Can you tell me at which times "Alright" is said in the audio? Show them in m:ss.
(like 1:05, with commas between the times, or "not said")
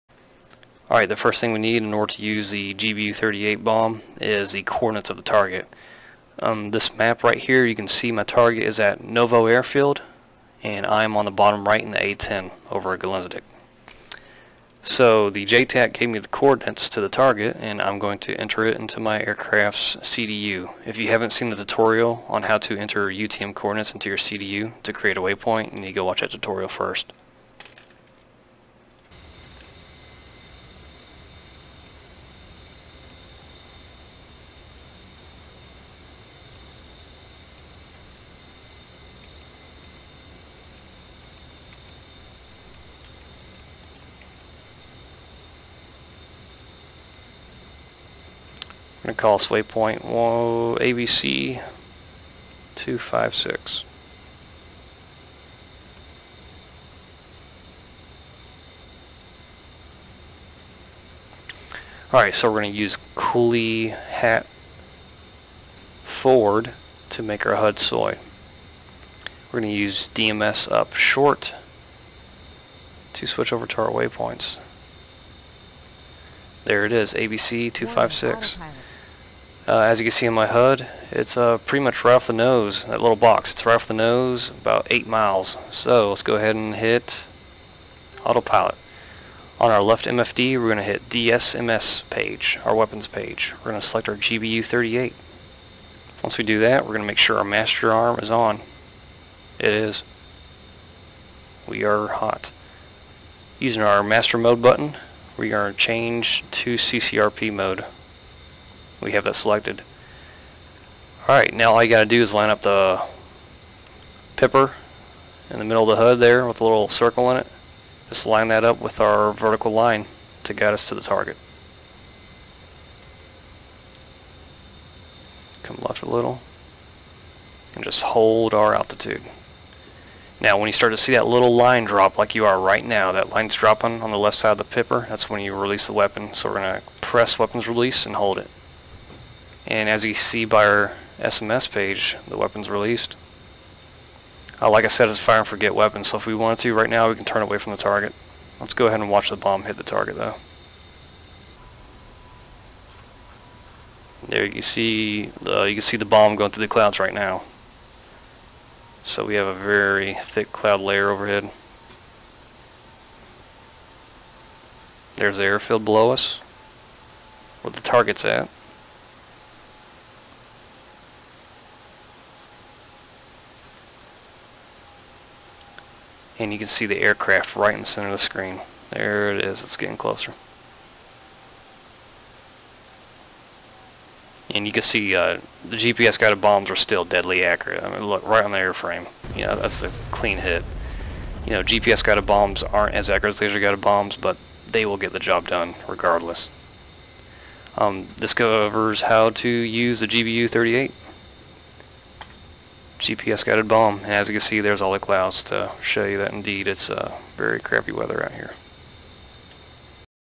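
0:00, 1:02, 1:51.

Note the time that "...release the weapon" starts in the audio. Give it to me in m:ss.
2:15.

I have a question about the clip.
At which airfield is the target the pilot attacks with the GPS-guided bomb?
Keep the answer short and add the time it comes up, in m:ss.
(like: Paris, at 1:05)
Novo Airfield, at 0:09.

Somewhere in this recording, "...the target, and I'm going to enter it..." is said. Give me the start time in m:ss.
0:16.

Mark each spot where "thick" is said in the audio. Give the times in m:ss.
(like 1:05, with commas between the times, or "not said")
2:40.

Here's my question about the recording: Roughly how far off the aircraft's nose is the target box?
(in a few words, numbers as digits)
8 miles.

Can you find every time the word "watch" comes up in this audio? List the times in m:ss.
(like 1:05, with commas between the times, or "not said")
0:26, 2:29.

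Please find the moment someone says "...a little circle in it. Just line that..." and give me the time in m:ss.
1:56.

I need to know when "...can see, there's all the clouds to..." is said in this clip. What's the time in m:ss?
3:24.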